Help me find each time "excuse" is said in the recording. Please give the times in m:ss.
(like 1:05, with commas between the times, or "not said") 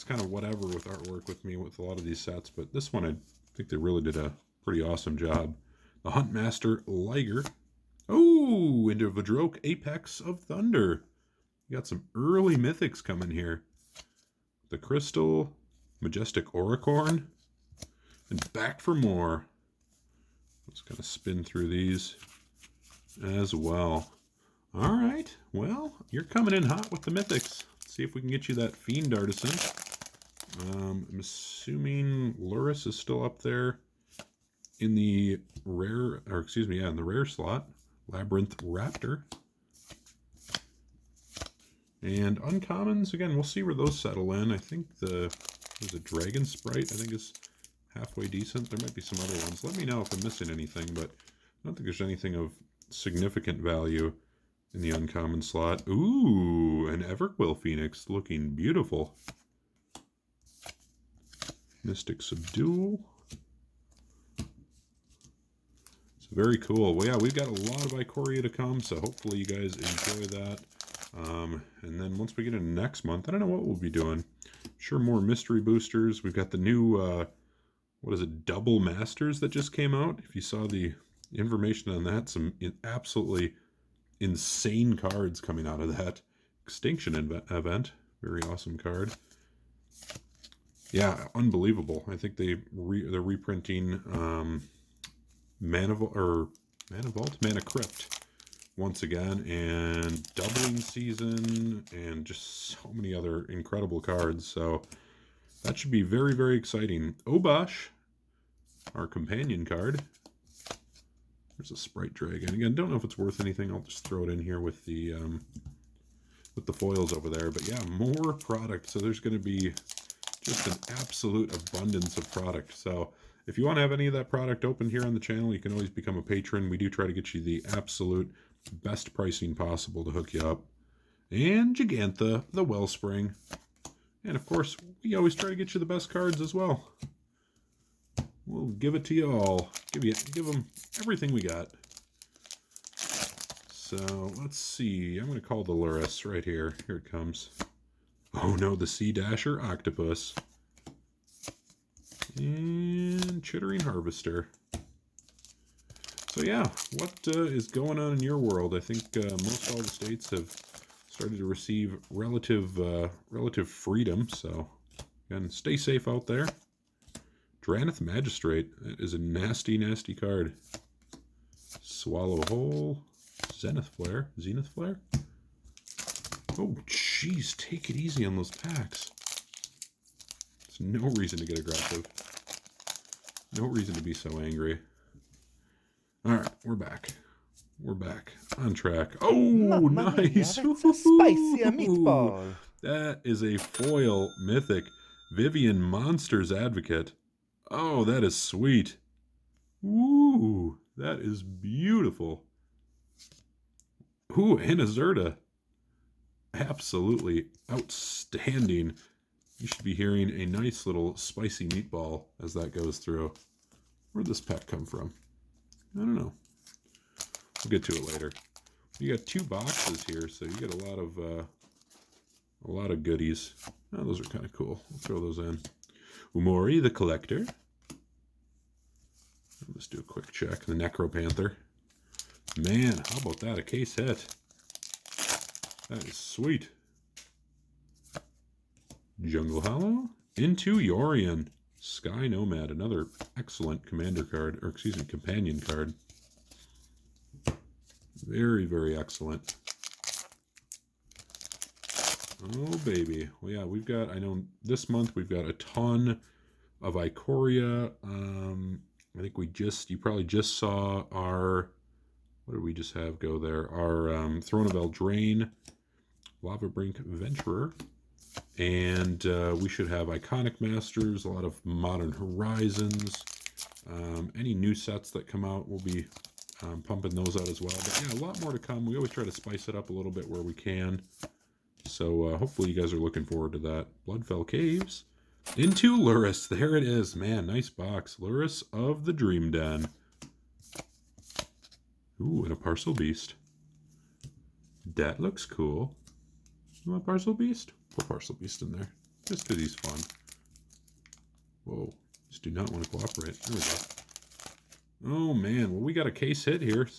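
0:36, 4:04.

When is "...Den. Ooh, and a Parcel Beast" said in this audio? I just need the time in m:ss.
4:49.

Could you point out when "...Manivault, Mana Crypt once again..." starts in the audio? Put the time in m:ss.
1:36.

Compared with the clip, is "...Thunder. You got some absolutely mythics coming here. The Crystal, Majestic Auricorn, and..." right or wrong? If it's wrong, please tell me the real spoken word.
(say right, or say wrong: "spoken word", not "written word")
wrong: "early", not "absolutely".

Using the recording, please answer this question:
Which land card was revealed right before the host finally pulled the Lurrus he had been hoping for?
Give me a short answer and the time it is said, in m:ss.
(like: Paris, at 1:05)
Bloodfell Caves, at 4:44.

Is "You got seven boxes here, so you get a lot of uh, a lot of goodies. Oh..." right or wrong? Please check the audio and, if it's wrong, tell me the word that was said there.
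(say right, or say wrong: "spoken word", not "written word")
wrong: "two", not "seven".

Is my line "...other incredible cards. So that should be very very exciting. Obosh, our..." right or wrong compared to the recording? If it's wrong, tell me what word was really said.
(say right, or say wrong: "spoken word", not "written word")
right.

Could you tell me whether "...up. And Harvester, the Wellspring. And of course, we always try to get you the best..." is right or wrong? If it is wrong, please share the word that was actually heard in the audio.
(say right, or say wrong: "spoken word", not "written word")
wrong: "Jegantha", not "Harvester".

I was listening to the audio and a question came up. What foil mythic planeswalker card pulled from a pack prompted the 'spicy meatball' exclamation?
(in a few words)
Vivien Monsters Advocate.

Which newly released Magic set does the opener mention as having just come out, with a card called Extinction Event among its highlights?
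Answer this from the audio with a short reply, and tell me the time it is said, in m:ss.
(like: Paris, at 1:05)
Double Masters, at 1:18.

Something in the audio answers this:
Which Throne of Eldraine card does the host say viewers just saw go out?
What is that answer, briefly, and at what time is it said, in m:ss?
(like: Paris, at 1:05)
Lavabrink Venturer, at 4:26.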